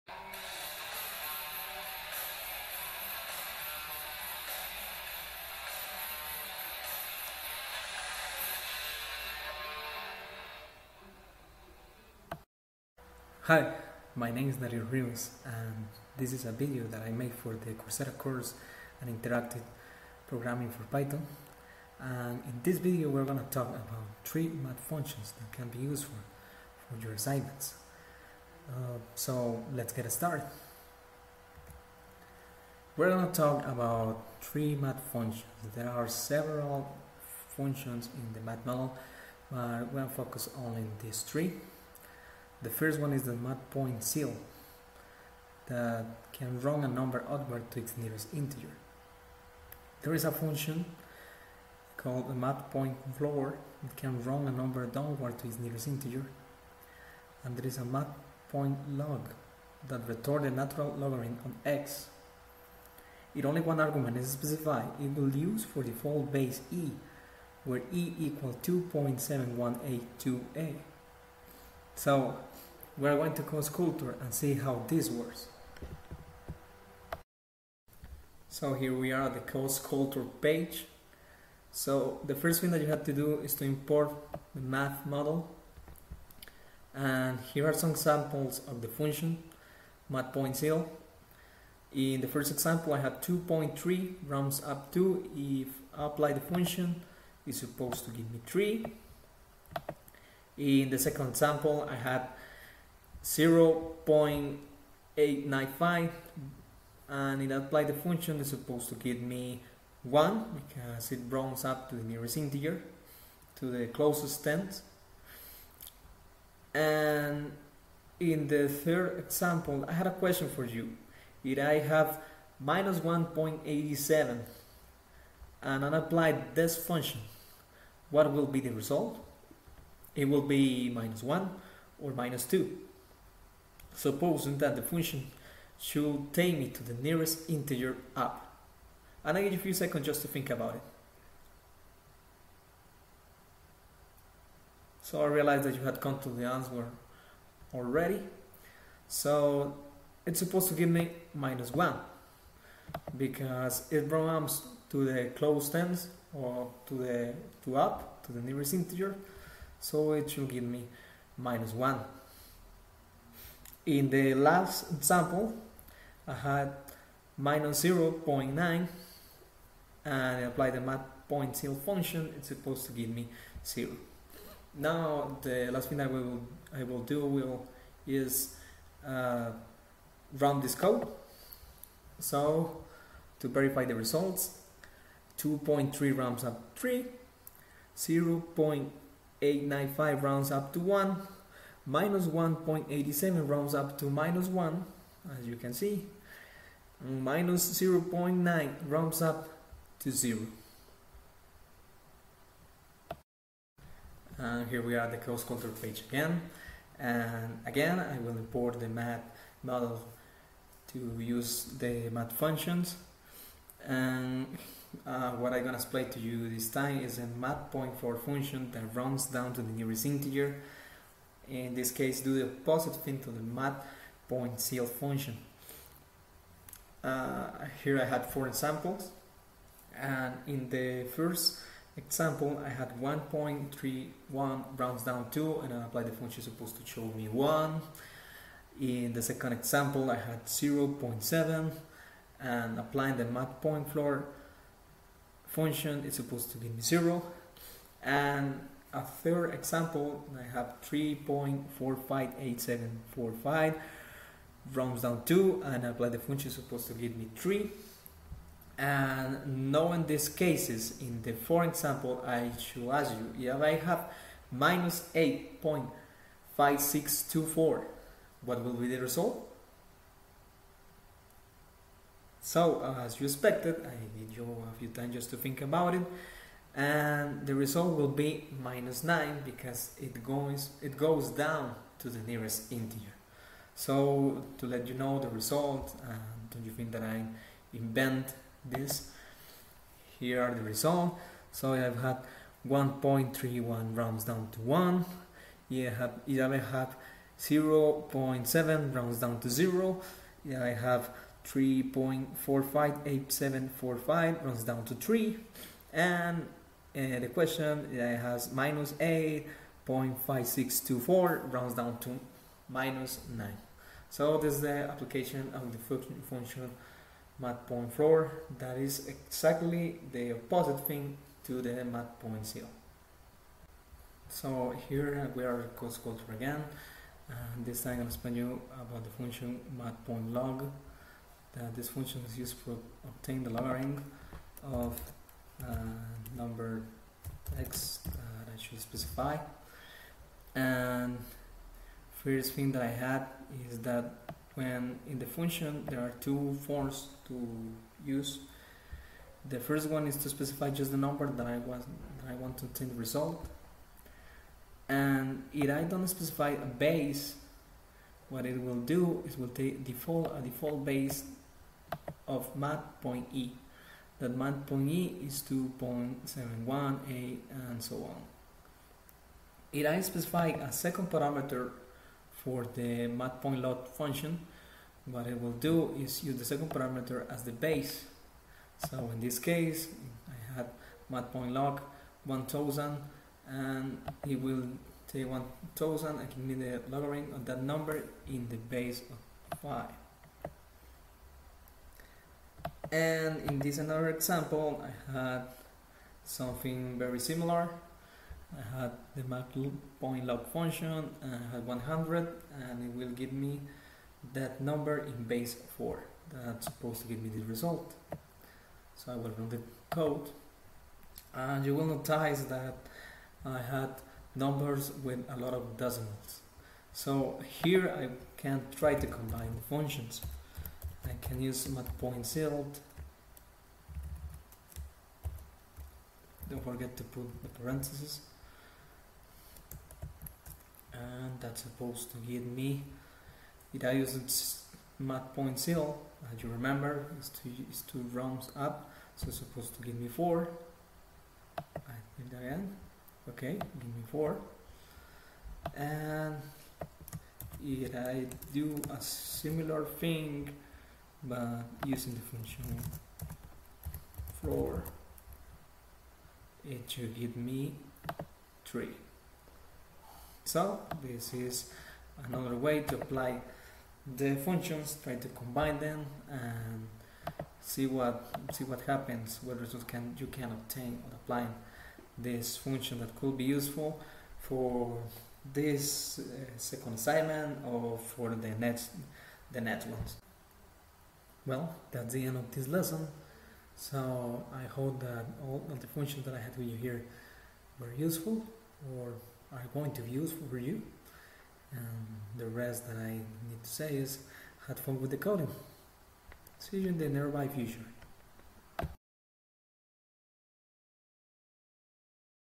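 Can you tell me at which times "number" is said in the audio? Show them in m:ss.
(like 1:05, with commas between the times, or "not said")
0:46, 0:54, 5:36, 5:50, 6:27, 6:44, 6:54.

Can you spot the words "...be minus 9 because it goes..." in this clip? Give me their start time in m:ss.
4:38.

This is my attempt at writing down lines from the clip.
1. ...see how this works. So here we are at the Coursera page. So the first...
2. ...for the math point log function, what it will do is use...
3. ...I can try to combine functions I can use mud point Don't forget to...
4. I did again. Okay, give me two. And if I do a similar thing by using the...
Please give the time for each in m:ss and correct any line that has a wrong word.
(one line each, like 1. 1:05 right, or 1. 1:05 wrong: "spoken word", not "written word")
1. 1:14 wrong: "CodeSkulptor", not "Coursera"
2. 6:12 right
3. 6:57 right
4. 7:21 wrong: "four", not "two".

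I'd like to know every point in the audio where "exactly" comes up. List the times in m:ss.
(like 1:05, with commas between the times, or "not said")
5:19.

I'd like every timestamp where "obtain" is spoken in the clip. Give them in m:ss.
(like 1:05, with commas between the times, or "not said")
5:33, 5:52, 7:50.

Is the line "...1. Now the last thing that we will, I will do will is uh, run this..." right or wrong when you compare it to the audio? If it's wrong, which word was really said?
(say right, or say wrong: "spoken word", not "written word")
wrong: "0", not "1".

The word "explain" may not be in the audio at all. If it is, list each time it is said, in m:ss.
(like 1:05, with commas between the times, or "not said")
3:35, 5:28.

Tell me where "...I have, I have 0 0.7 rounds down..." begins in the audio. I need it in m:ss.
4:55.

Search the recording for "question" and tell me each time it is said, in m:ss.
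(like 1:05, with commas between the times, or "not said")
2:00, 5:07.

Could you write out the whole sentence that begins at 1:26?
And here are some examples of the function math.ceil.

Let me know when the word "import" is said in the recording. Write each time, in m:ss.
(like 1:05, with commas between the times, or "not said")
1:23, 3:28.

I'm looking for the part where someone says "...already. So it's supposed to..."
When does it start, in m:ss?
2:27.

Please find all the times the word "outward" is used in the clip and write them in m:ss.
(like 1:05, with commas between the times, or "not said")
0:47.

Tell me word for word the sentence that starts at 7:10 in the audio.
And that's supposed to give me.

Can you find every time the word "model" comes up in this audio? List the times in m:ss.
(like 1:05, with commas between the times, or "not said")
0:38, 1:25, 3:29.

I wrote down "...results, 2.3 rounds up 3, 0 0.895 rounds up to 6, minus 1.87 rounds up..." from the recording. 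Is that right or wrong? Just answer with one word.
wrong.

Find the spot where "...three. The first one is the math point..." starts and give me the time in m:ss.
0:41.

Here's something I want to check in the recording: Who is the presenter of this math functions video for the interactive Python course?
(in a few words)
Dario Rios.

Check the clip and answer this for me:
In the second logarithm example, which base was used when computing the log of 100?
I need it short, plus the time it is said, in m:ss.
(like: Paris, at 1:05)
4, at 6:45.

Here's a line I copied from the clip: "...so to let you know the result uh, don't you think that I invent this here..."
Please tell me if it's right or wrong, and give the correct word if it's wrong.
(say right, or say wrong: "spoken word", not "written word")
right.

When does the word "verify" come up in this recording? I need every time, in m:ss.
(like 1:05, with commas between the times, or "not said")
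3:03.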